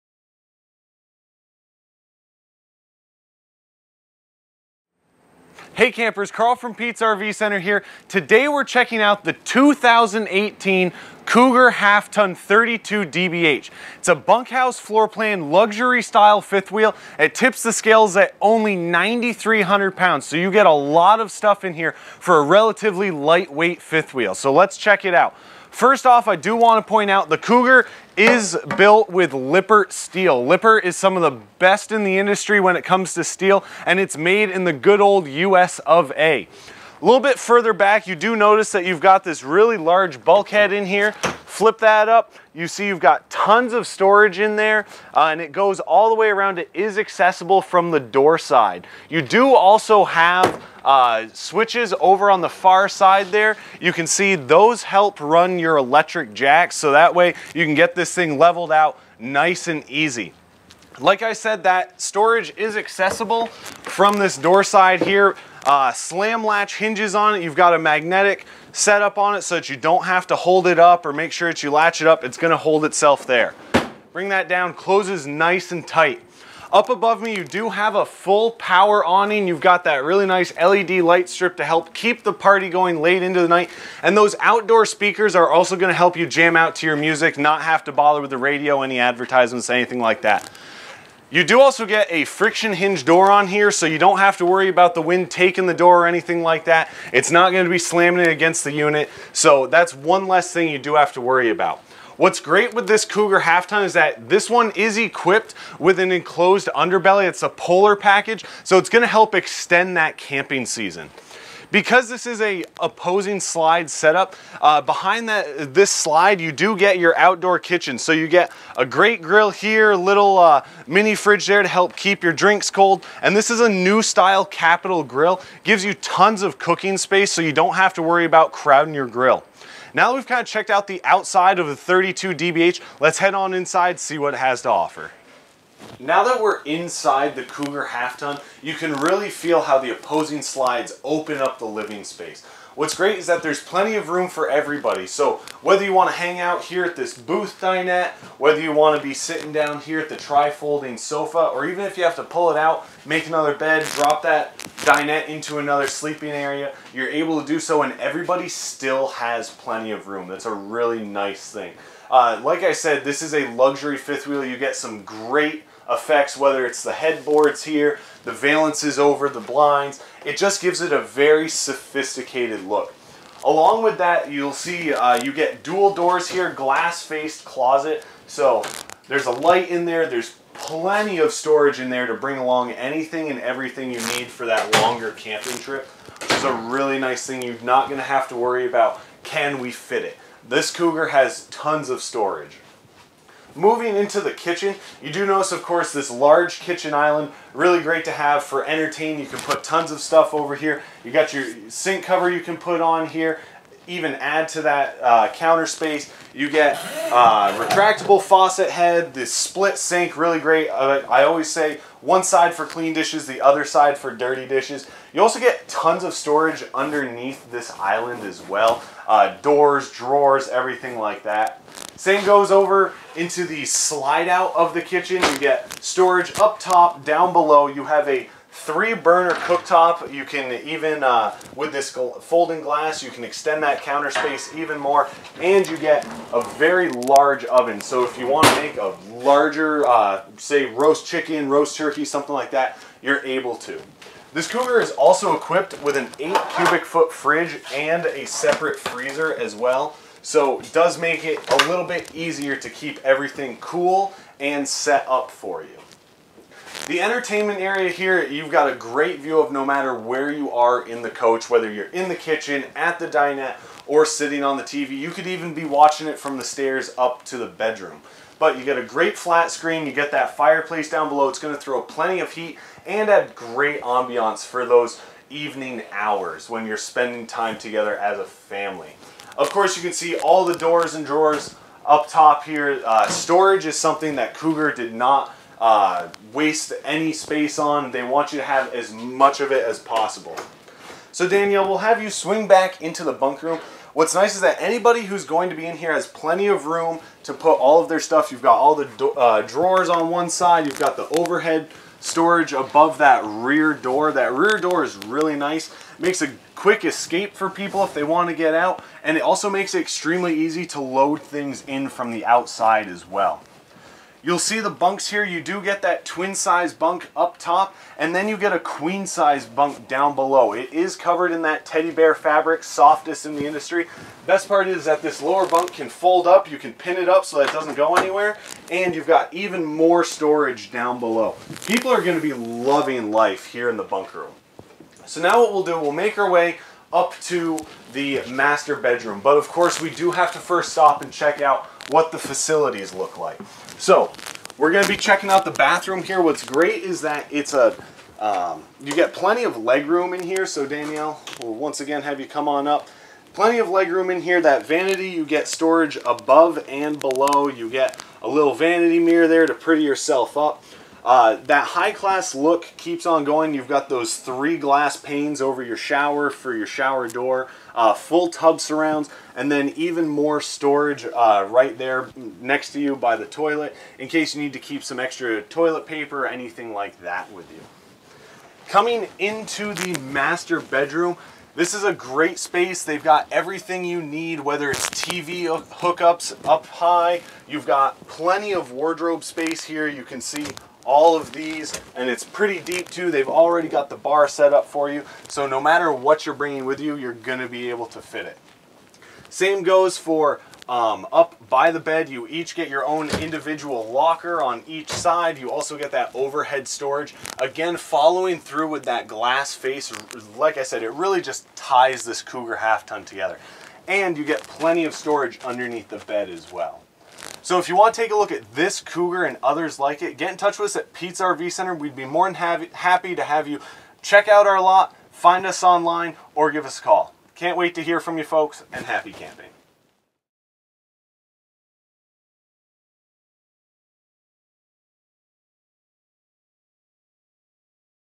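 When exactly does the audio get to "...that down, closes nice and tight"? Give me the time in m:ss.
1:14.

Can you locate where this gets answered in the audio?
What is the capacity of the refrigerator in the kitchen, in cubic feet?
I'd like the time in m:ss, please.
4:06.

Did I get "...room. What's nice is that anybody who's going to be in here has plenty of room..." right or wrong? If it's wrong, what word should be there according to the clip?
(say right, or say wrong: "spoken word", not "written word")
right.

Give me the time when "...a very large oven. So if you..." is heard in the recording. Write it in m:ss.
3:56.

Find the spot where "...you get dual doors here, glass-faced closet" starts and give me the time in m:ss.
2:55.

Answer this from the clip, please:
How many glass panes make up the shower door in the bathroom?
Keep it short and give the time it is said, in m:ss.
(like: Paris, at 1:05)
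3, at 6:04.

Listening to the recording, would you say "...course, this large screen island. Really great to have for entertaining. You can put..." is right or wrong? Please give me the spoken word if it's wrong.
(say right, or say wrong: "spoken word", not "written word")
wrong: "kitchen", not "screen".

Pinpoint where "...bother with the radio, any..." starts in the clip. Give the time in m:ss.
1:27.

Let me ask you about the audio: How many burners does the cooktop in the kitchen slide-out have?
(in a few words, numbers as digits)
3.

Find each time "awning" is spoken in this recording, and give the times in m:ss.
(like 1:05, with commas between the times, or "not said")
1:19.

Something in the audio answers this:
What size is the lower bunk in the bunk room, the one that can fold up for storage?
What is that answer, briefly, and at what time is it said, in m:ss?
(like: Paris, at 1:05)
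queen, at 5:18.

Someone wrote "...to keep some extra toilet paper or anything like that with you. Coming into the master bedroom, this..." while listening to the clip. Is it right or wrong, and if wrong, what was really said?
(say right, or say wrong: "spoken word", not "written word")
right.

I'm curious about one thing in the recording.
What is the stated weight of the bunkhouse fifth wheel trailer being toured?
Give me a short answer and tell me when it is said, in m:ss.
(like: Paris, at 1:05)
9,300 pounds, at 0:18.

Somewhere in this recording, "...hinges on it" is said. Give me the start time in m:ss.
1:06.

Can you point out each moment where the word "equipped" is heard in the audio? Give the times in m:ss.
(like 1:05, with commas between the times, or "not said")
1:44, 4:05.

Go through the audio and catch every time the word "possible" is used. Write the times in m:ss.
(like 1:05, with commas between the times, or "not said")
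4:49.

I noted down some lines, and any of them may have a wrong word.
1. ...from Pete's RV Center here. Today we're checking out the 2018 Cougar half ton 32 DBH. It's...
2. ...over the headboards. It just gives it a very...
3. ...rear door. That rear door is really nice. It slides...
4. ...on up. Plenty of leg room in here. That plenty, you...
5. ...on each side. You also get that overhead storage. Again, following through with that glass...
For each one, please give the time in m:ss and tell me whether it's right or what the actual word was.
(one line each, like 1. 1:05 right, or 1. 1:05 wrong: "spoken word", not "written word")
1. 0:06 right
2. 2:48 wrong: "blinds", not "headboards"
3. 5:03 wrong: "makes", not "slides"
4. 5:52 wrong: "vanity", not "plenty"
5. 6:44 right.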